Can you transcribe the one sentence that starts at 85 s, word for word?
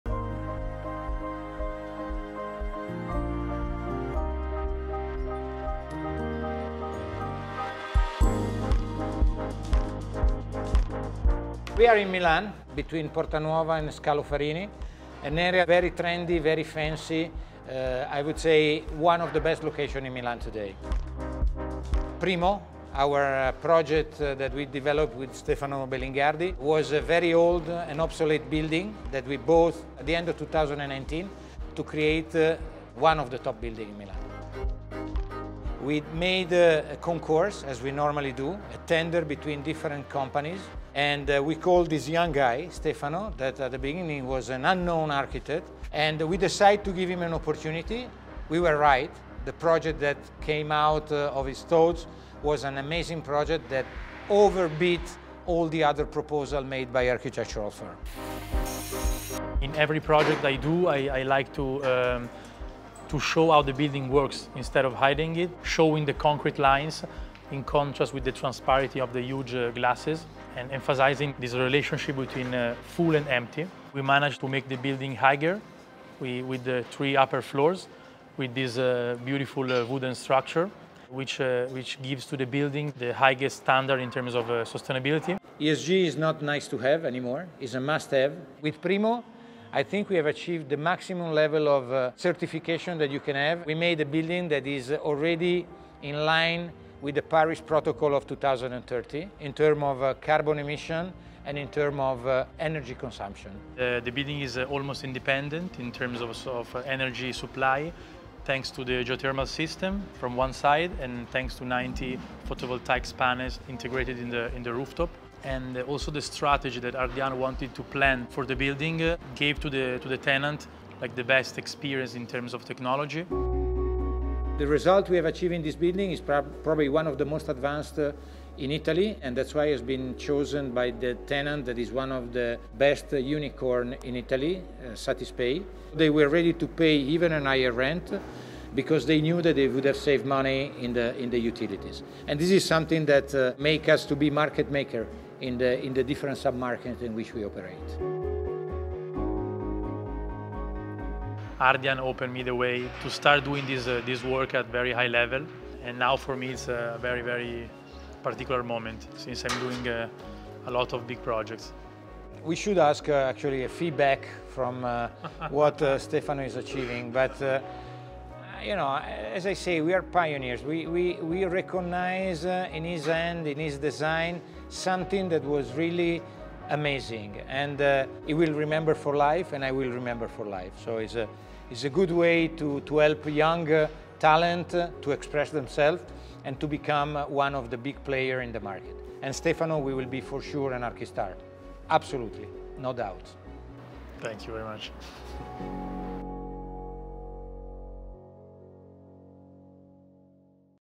ESG is not nice to have anymore, it's a must have.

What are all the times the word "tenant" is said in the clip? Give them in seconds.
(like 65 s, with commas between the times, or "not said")
120 s, 131 s.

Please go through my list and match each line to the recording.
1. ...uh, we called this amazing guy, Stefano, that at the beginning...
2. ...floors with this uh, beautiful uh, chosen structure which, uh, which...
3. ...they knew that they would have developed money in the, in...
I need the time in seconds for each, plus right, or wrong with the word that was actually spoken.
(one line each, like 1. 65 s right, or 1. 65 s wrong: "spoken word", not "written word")
1. 41 s wrong: "young", not "amazing"
2. 77 s wrong: "wooden", not "chosen"
3. 139 s wrong: "saved", not "developed".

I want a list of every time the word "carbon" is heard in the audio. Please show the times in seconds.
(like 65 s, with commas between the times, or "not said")
100 s.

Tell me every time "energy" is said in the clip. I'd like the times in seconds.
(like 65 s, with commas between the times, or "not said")
102 s, 106 s.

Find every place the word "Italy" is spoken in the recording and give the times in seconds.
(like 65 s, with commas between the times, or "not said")
128 s, 134 s.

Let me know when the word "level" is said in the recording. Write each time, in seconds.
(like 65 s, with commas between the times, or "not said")
91 s, 155 s.